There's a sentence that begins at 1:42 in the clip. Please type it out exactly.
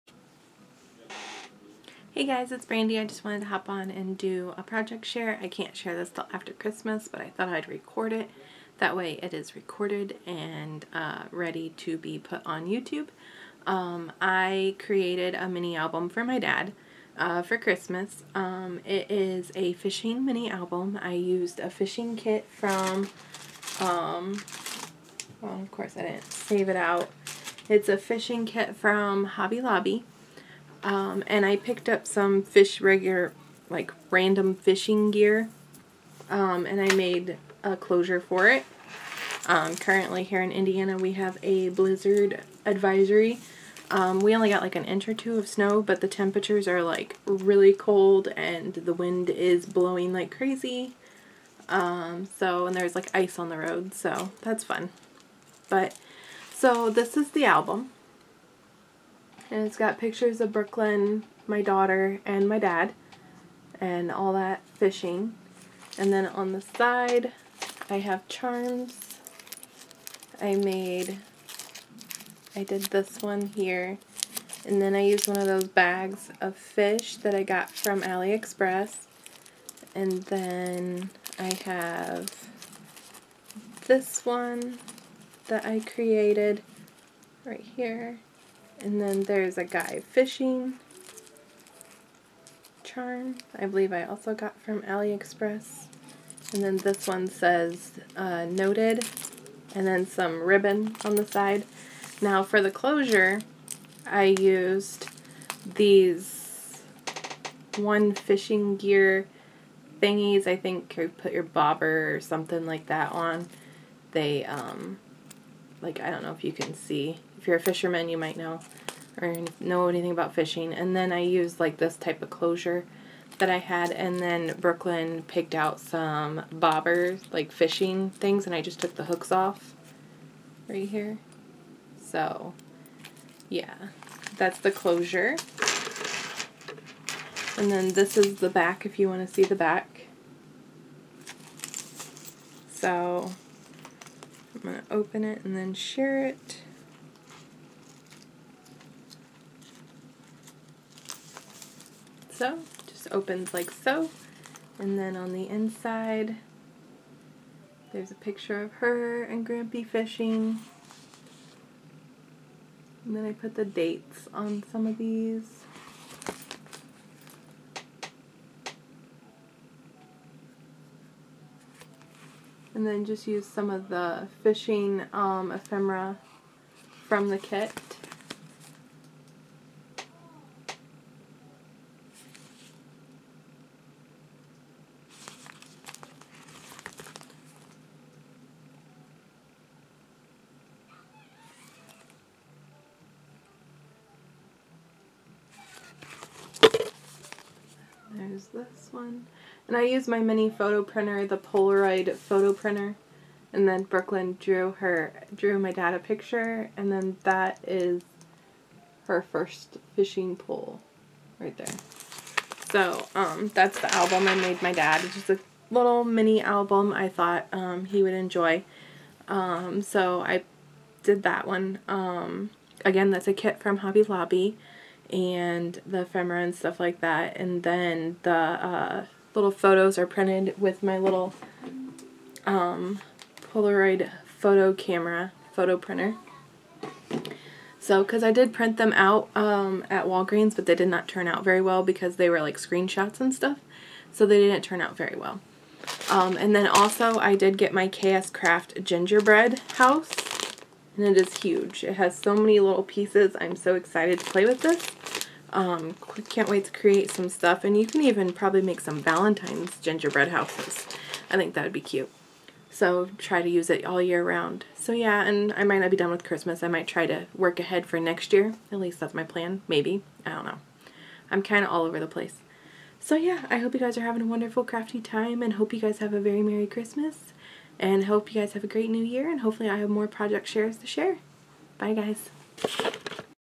Now for the closure, I used these one fishing gear thingies.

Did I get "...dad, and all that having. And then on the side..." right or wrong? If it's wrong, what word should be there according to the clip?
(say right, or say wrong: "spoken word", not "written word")
wrong: "fishing", not "having".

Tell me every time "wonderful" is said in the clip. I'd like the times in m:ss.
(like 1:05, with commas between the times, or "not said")
4:34.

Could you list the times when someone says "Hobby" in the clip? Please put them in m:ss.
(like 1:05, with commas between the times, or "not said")
0:29, 3:43.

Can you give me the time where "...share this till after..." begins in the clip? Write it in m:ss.
0:05.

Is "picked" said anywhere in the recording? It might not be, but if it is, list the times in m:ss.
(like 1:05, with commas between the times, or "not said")
0:31, 2:05.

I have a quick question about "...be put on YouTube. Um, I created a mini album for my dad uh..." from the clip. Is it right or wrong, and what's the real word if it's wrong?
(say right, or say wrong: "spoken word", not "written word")
right.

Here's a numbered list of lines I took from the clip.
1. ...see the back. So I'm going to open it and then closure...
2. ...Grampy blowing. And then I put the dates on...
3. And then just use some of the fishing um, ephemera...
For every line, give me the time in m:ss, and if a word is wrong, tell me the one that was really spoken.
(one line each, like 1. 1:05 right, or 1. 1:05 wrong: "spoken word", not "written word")
1. 2:19 wrong: "share", not "closure"
2. 2:39 wrong: "fishing", not "blowing"
3. 2:52 right.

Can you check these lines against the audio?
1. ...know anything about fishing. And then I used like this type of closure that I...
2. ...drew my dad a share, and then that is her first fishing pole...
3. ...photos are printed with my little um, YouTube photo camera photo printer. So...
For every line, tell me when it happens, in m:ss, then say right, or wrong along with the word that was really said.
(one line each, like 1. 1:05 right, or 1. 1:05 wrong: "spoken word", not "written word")
1. 1:59 right
2. 3:25 wrong: "picture", not "share"
3. 3:49 wrong: "Polaroid", not "YouTube".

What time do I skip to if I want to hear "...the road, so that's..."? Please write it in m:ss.
0:53.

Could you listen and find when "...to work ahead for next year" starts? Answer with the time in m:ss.
4:27.